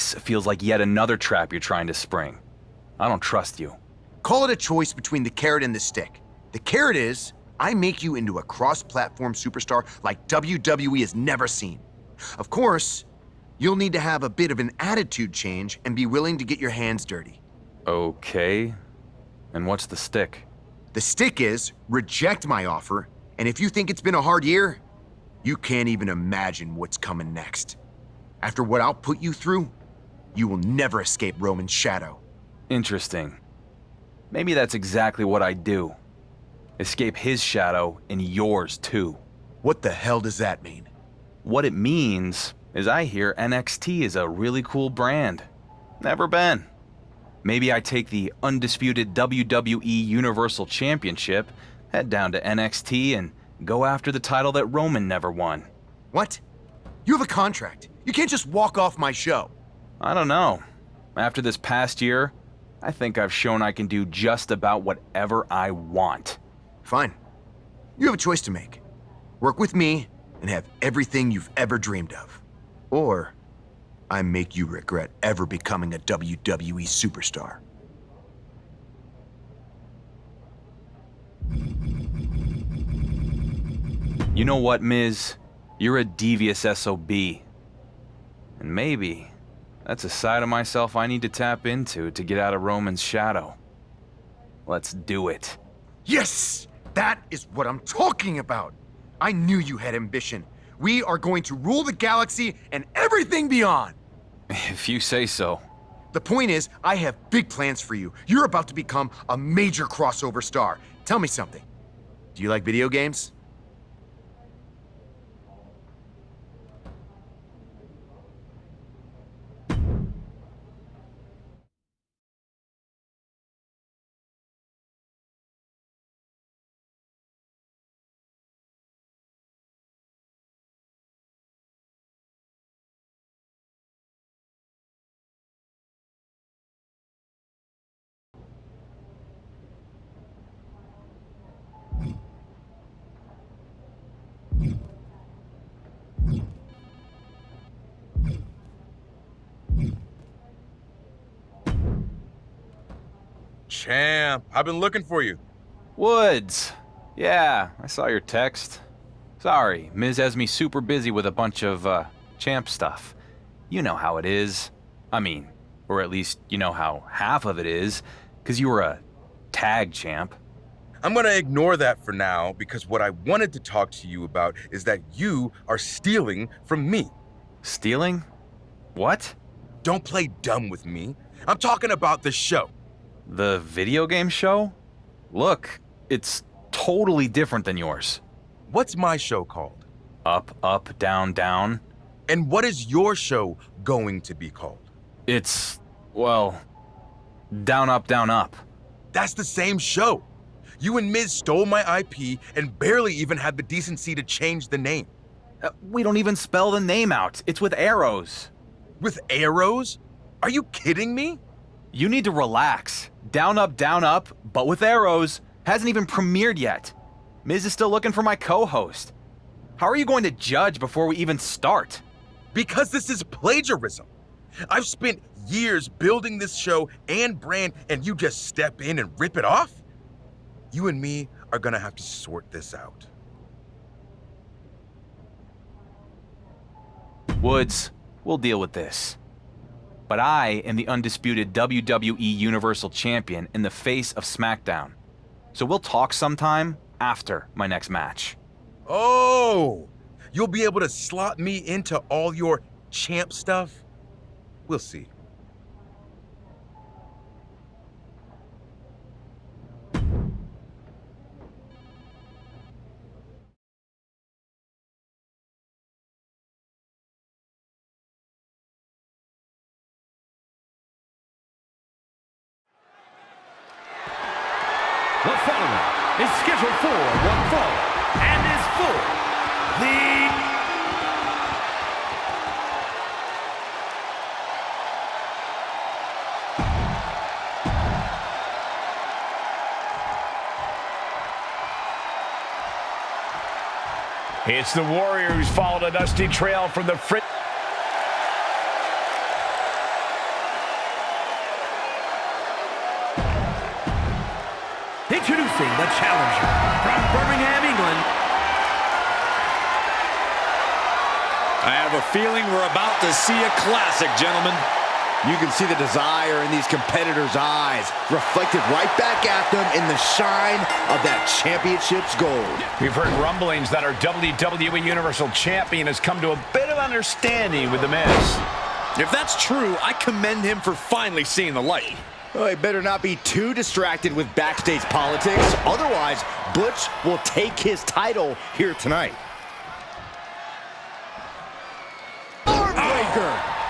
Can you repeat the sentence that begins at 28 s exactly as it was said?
After what I'll put you through, you will never escape Roman's shadow.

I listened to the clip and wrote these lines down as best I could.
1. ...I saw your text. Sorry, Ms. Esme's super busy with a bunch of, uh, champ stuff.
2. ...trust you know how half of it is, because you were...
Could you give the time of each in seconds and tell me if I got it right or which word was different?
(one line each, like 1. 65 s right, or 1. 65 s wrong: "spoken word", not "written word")
1. 157 s right
2. 166 s wrong: "least", not "trust".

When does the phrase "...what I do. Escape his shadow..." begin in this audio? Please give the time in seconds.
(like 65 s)
35 s.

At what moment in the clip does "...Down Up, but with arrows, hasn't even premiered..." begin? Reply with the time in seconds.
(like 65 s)
213 s.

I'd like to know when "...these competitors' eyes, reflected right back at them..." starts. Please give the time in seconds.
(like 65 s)
316 s.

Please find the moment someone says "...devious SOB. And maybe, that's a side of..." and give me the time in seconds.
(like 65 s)
86 s.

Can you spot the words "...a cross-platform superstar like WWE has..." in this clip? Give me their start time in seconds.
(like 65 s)
8 s.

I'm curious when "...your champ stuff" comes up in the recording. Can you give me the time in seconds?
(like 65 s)
252 s.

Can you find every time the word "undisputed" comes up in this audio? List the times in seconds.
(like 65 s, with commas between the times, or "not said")
48 s, 240 s.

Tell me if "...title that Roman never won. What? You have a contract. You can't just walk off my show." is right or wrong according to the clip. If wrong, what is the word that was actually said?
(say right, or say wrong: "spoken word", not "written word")
right.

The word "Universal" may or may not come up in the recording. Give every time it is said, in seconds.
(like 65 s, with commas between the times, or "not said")
50 s, 242 s, 324 s.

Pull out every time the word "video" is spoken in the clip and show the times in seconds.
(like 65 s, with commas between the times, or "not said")
112 s, 183 s.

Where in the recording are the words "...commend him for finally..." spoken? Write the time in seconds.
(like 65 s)
329 s.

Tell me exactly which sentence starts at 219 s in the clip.
How are you going to judge before we even start?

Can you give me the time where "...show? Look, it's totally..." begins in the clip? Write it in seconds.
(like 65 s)
184 s.